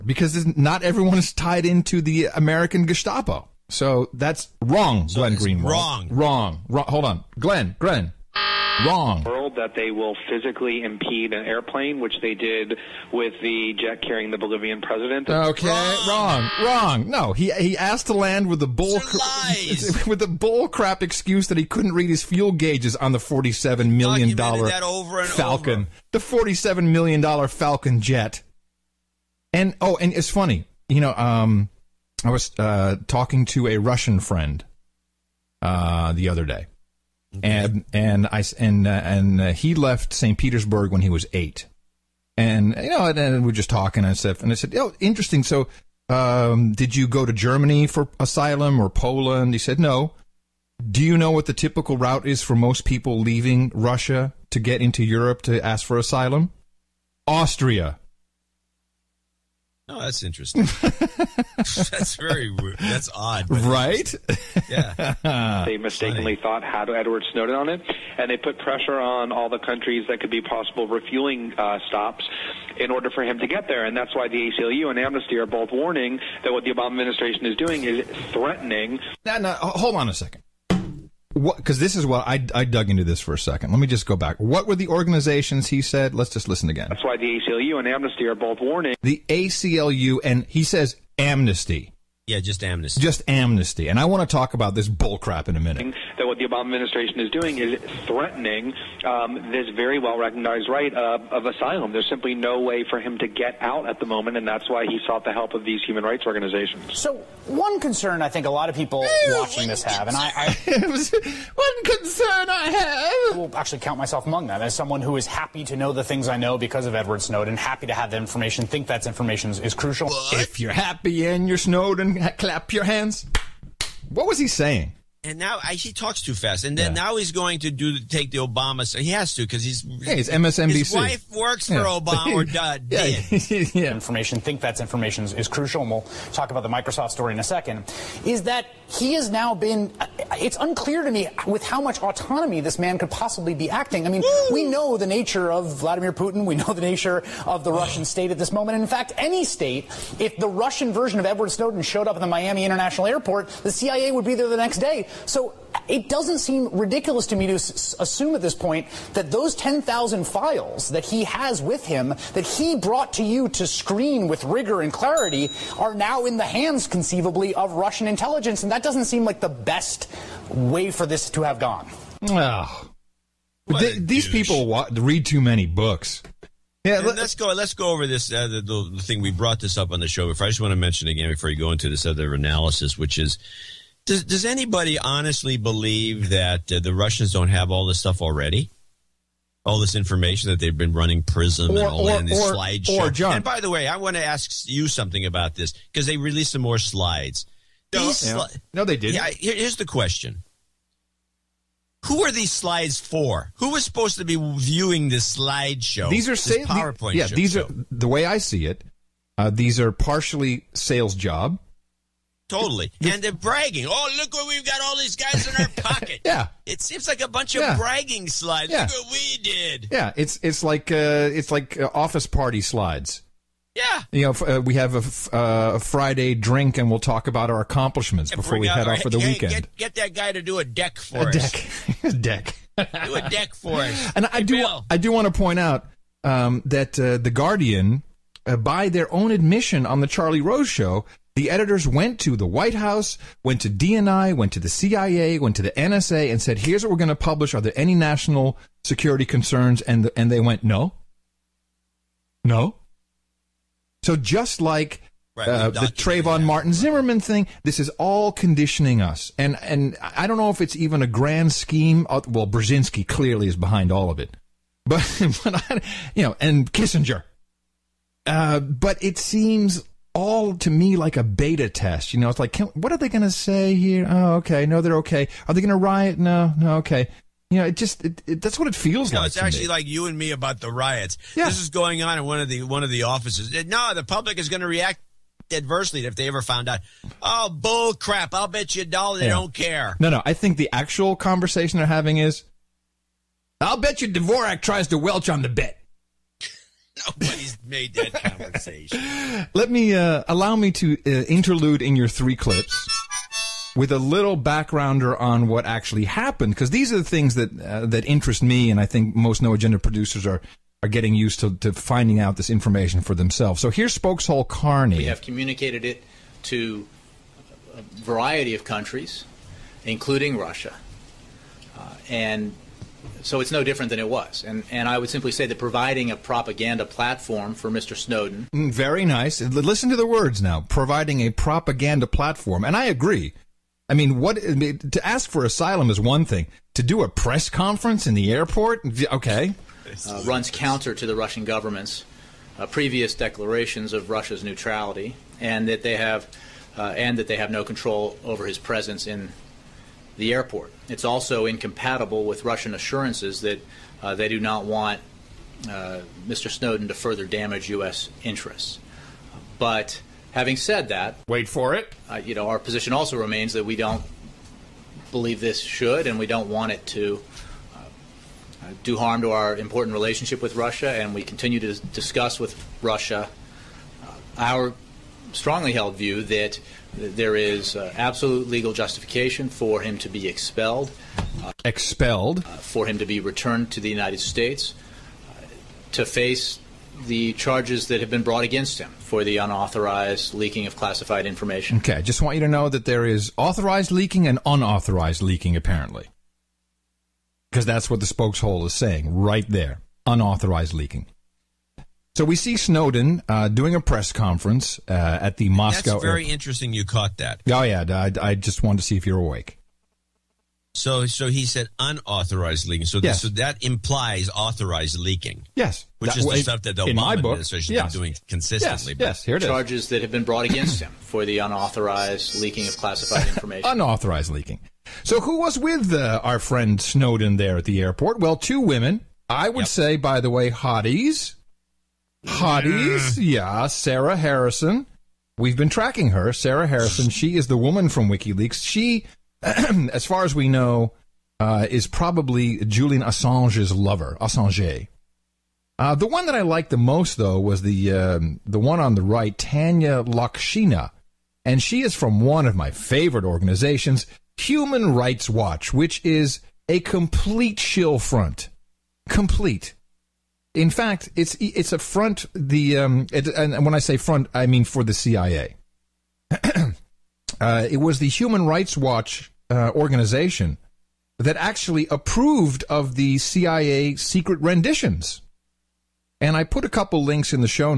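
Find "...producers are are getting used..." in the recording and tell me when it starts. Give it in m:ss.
5:09.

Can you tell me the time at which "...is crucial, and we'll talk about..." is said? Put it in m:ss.
2:15.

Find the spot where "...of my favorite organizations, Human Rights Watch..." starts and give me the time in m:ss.
7:32.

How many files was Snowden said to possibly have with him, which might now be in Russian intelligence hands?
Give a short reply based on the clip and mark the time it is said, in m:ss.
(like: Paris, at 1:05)
10,000, at 2:39.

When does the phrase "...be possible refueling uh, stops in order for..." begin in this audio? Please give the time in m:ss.
1:10.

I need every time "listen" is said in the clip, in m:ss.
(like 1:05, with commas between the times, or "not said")
1:26, 5:29.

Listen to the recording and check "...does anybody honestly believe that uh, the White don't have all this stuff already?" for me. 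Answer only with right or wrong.
wrong.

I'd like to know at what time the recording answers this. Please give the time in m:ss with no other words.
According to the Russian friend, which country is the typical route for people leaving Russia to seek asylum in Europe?
0:57.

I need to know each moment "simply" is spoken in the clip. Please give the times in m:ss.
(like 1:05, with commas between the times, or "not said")
1:42, 5:25.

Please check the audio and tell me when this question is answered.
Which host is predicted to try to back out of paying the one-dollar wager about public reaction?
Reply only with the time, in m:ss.
4:54.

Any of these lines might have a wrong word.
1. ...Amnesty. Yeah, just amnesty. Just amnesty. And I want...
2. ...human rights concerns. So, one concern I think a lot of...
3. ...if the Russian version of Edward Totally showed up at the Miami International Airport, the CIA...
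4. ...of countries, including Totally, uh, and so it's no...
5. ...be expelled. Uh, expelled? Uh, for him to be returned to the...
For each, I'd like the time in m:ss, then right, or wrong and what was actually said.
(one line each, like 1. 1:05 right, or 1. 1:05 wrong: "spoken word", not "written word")
1. 1:31 right
2. 1:45 wrong: "organizations", not "concerns"
3. 2:30 wrong: "Snowden", not "Totally"
4. 5:18 wrong: "Russia", not "Totally"
5. 6:20 right.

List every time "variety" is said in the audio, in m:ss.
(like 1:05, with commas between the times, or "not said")
5:17.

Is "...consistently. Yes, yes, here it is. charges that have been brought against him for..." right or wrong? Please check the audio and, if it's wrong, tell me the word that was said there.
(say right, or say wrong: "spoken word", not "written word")
right.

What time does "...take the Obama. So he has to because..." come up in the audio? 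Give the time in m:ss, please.
2:07.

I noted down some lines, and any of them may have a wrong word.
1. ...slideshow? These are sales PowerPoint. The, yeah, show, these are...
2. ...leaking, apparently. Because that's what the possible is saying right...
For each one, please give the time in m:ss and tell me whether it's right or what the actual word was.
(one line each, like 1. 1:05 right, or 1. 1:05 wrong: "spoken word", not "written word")
1. 3:25 right
2. 6:35 wrong: "spokeshole", not "possible".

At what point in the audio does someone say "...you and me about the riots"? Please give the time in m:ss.
4:39.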